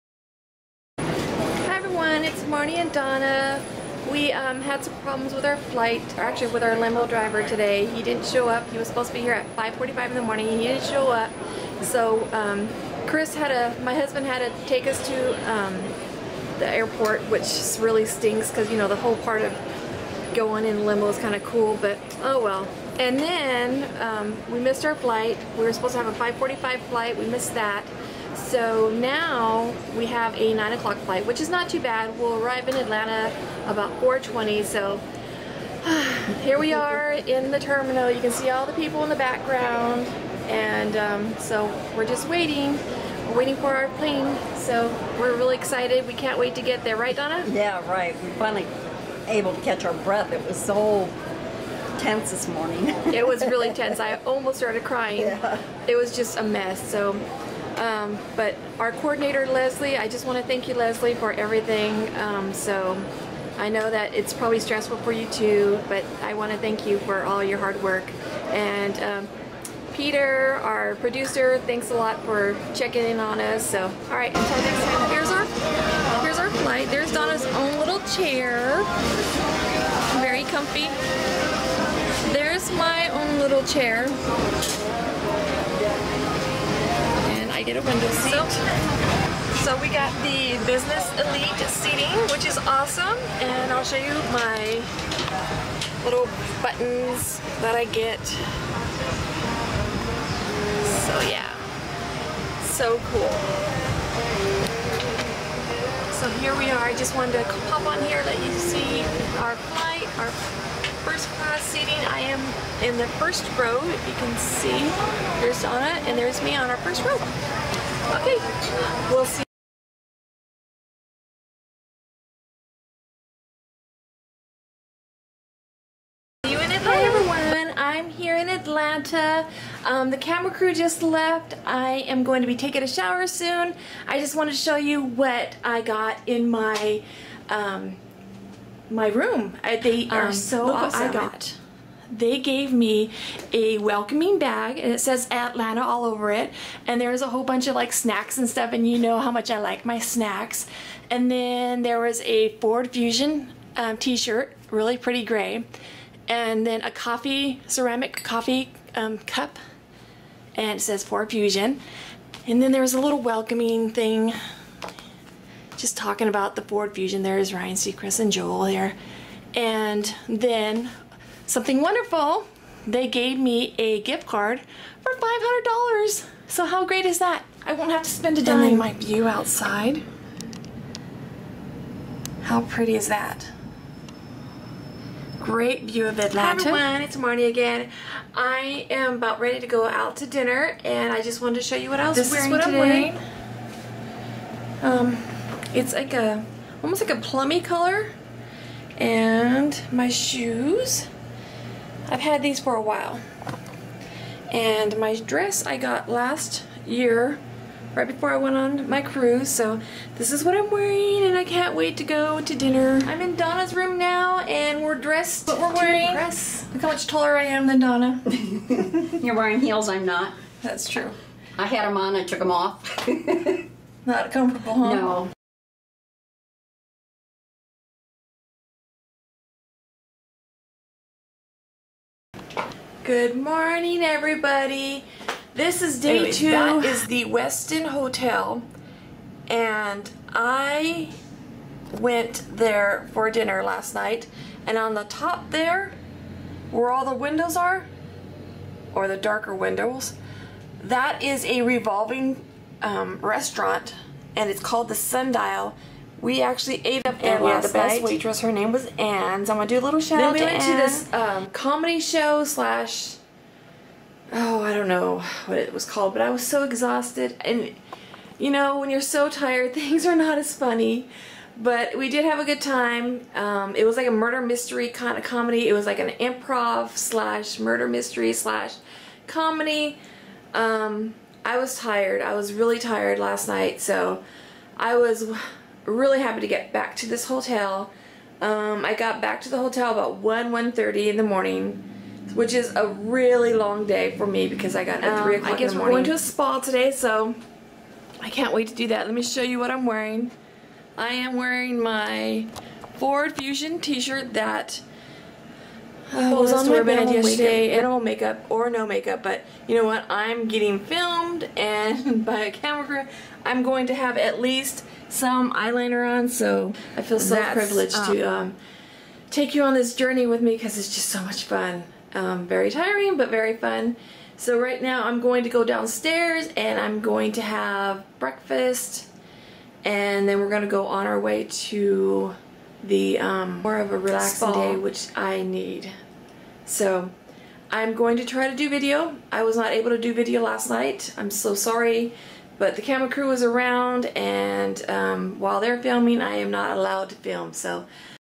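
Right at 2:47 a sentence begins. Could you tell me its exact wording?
There's Ryan Seacrest and Joel there.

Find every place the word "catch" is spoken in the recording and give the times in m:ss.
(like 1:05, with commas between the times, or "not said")
0:49.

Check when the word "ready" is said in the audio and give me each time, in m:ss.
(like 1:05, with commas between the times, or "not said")
3:09.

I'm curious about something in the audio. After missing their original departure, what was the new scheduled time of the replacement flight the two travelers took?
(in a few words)
9 o'clock.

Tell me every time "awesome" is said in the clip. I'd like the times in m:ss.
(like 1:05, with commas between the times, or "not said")
1:32, 2:20.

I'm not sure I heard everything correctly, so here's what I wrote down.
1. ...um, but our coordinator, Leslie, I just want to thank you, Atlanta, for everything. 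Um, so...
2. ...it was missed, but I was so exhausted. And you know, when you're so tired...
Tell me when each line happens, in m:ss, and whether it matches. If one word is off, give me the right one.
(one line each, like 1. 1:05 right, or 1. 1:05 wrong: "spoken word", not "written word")
1. 0:57 wrong: "Leslie", not "Atlanta"
2. 4:25 wrong: "called", not "missed".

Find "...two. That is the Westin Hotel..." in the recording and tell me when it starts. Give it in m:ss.
3:56.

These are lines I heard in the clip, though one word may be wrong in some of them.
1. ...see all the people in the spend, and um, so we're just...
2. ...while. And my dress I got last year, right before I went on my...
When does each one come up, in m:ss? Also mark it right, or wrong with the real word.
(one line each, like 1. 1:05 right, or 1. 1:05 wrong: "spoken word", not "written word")
1. 0:38 wrong: "background", not "spend"
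2. 3:22 right.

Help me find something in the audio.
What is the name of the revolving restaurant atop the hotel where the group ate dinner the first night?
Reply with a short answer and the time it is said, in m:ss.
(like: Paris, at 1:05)
Sundial, at 4:14.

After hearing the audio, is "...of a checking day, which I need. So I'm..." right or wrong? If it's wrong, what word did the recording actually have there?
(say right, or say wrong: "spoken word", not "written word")
wrong: "relaxing", not "checking".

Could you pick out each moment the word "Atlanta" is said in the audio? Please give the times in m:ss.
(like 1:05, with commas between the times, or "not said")
0:32, 2:08, 2:25, 3:06.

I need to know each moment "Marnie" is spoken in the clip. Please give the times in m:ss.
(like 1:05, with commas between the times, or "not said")
0:02, 3:07.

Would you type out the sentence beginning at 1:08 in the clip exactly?
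And um, Peter, our producer, thanks a lot for checking in on us.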